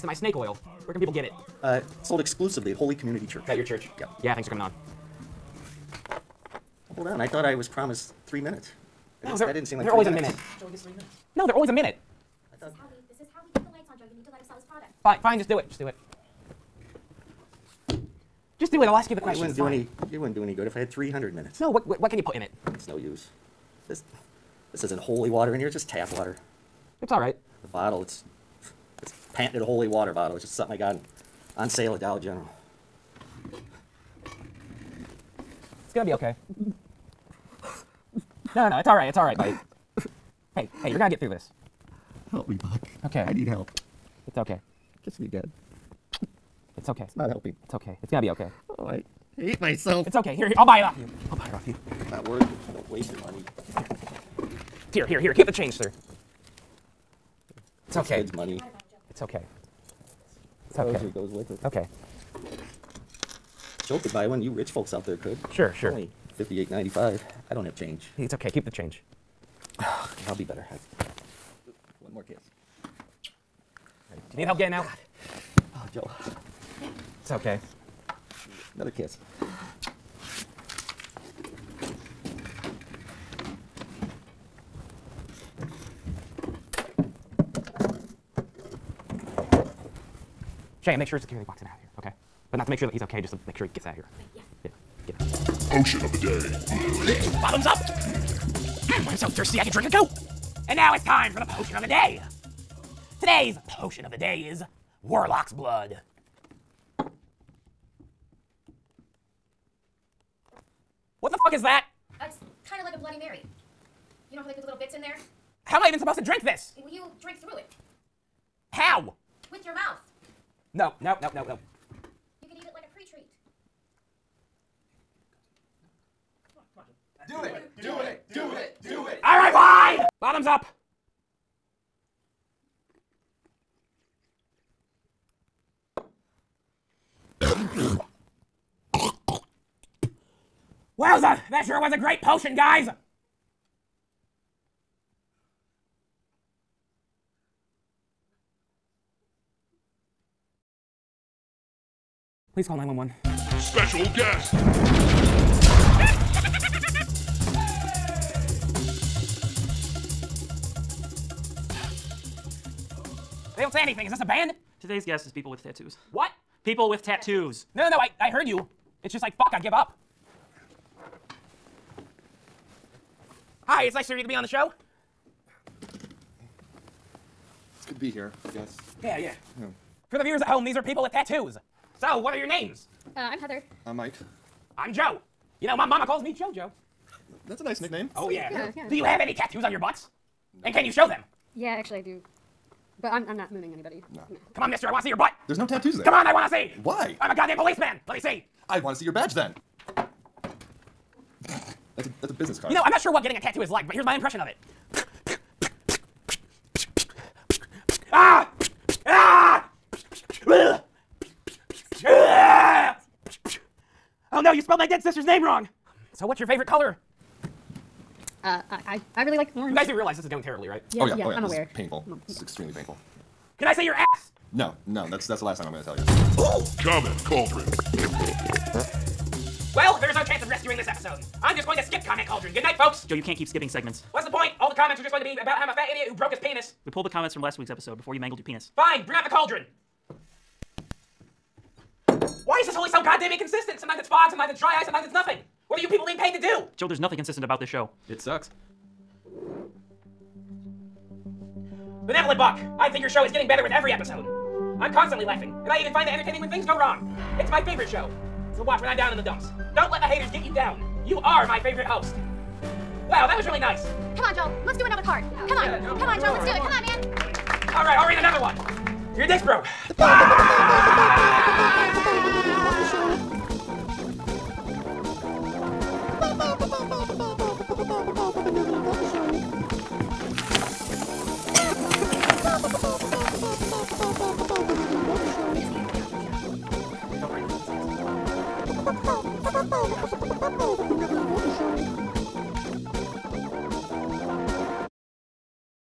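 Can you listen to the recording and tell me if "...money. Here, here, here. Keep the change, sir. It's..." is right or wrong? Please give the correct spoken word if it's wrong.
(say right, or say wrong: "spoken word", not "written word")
right.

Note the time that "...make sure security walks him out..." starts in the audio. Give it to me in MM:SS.
01:30.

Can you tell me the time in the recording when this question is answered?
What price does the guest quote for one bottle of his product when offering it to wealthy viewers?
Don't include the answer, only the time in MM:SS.
01:06.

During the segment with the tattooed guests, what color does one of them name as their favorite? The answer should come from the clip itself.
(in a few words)
Orange.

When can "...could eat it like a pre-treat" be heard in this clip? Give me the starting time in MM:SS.
02:02.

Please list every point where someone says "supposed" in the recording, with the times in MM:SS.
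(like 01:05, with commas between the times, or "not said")
01:55.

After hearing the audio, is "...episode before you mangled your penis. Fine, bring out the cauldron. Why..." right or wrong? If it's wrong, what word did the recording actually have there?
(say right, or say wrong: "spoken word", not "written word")
right.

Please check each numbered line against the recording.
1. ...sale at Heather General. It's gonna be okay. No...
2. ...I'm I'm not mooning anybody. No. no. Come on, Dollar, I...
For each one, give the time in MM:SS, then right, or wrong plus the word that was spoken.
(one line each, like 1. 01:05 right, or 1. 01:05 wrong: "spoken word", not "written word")
1. 00:31 wrong: "Dollar", not "Heather"
2. 03:13 wrong: "Mister", not "Dollar".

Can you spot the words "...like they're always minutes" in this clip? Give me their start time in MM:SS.
00:09.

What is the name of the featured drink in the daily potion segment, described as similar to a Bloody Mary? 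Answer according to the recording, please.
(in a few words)
Warlock's Blood.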